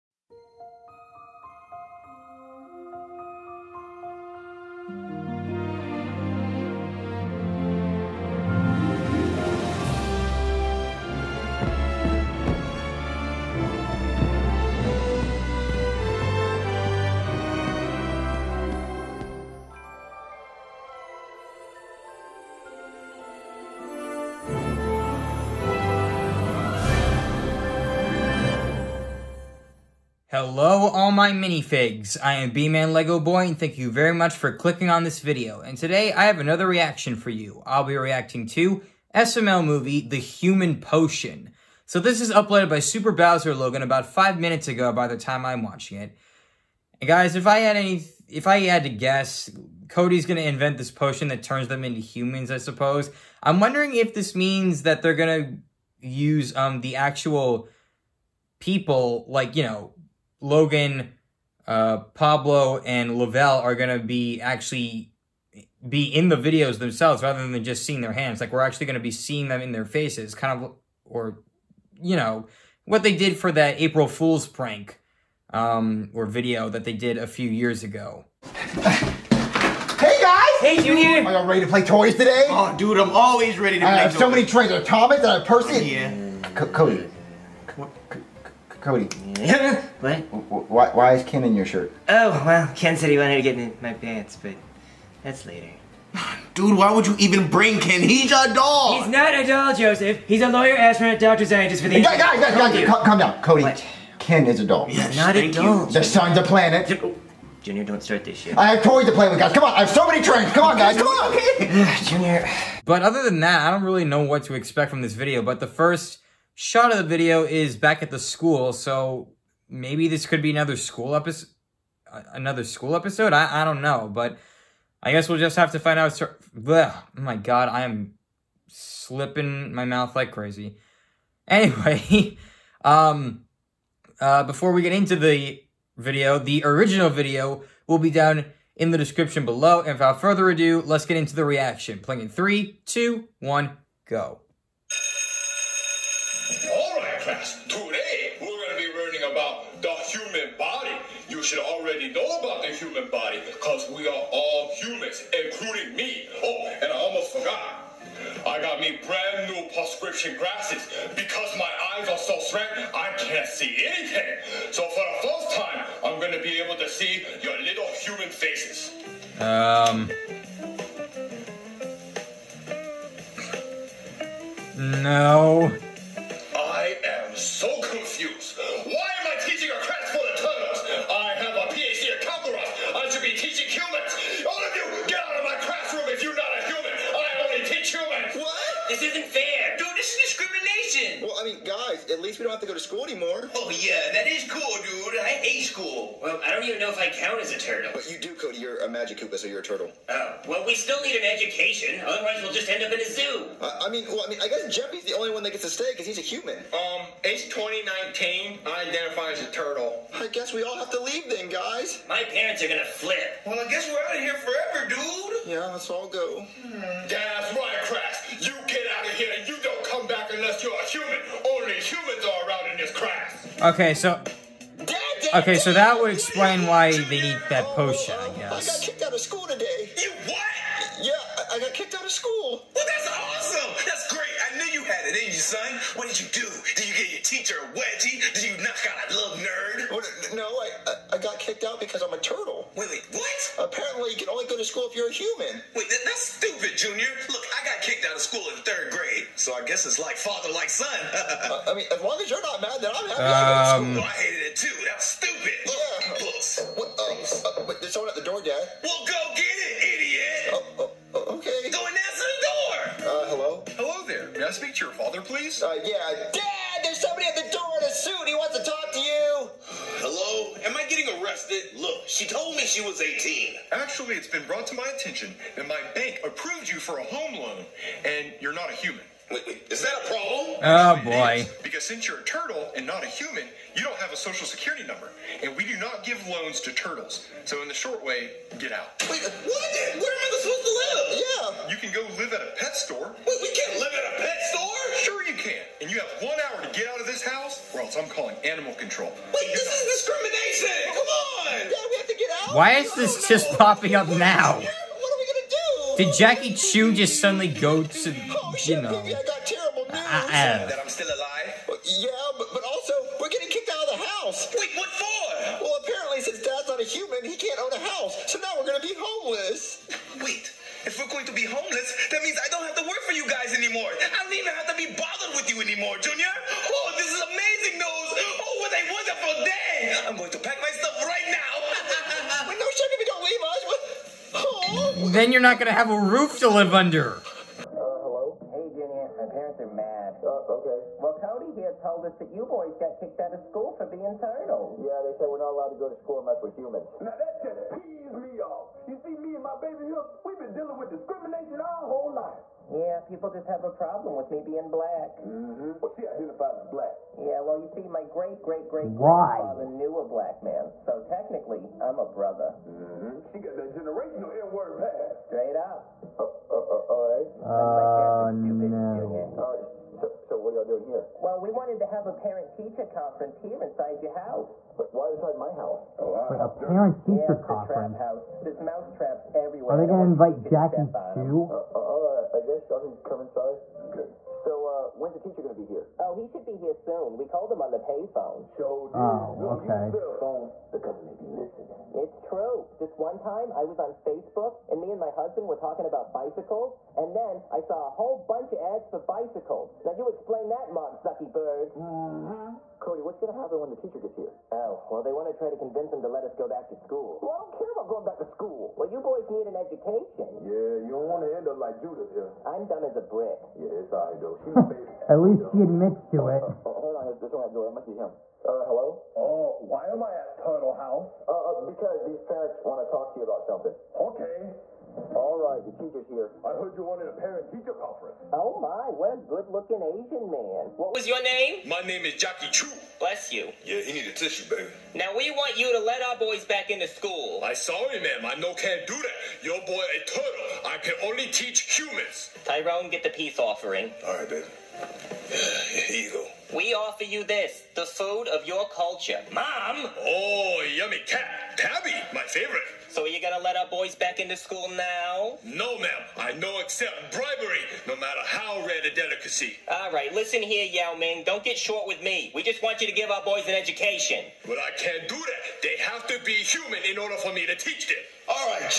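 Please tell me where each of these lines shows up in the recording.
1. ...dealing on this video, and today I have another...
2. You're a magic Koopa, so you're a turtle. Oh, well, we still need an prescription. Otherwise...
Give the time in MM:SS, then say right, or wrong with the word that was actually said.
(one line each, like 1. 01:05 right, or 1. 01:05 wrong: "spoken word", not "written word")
1. 00:34 wrong: "clicking", not "dealing"
2. 03:18 wrong: "education", not "prescription".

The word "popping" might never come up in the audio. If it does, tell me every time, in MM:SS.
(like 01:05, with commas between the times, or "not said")
05:03.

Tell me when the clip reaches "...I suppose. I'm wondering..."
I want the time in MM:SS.
00:52.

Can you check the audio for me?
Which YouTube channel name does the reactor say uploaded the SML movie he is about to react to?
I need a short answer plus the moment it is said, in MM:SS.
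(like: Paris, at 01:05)
Super Bowser Logan, at 00:42.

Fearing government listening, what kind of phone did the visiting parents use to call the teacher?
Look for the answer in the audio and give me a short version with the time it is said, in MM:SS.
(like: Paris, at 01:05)
payphone, at 06:27.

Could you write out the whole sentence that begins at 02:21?
Playing in three, two, one, go.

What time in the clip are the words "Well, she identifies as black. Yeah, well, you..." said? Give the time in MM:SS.
05:55.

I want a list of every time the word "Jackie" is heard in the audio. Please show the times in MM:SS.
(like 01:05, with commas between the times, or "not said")
05:06, 06:20, 07:12.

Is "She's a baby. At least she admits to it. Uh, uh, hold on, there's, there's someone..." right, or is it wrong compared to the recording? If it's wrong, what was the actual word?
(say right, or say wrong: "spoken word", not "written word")
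right.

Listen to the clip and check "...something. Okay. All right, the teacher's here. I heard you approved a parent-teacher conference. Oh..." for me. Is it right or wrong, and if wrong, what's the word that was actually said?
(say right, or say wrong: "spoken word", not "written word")
wrong: "wanted", not "approved".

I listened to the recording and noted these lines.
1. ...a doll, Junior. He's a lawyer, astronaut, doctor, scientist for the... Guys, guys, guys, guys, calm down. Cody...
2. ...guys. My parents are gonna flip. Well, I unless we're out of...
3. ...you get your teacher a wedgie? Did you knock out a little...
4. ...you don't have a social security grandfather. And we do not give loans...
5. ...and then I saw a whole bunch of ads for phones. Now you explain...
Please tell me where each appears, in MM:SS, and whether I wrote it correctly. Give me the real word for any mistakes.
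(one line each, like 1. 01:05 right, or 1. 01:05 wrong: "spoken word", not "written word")
1. 01:39 wrong: "Joseph", not "Junior"
2. 03:31 wrong: "guess", not "unless"
3. 03:56 right
4. 04:43 wrong: "number", not "grandfather"
5. 06:36 wrong: "bicycles", not "phones".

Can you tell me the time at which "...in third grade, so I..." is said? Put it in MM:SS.
04:08.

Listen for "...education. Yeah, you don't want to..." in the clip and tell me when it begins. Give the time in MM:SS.
06:49.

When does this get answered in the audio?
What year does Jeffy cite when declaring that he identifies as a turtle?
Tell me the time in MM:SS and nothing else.
03:27.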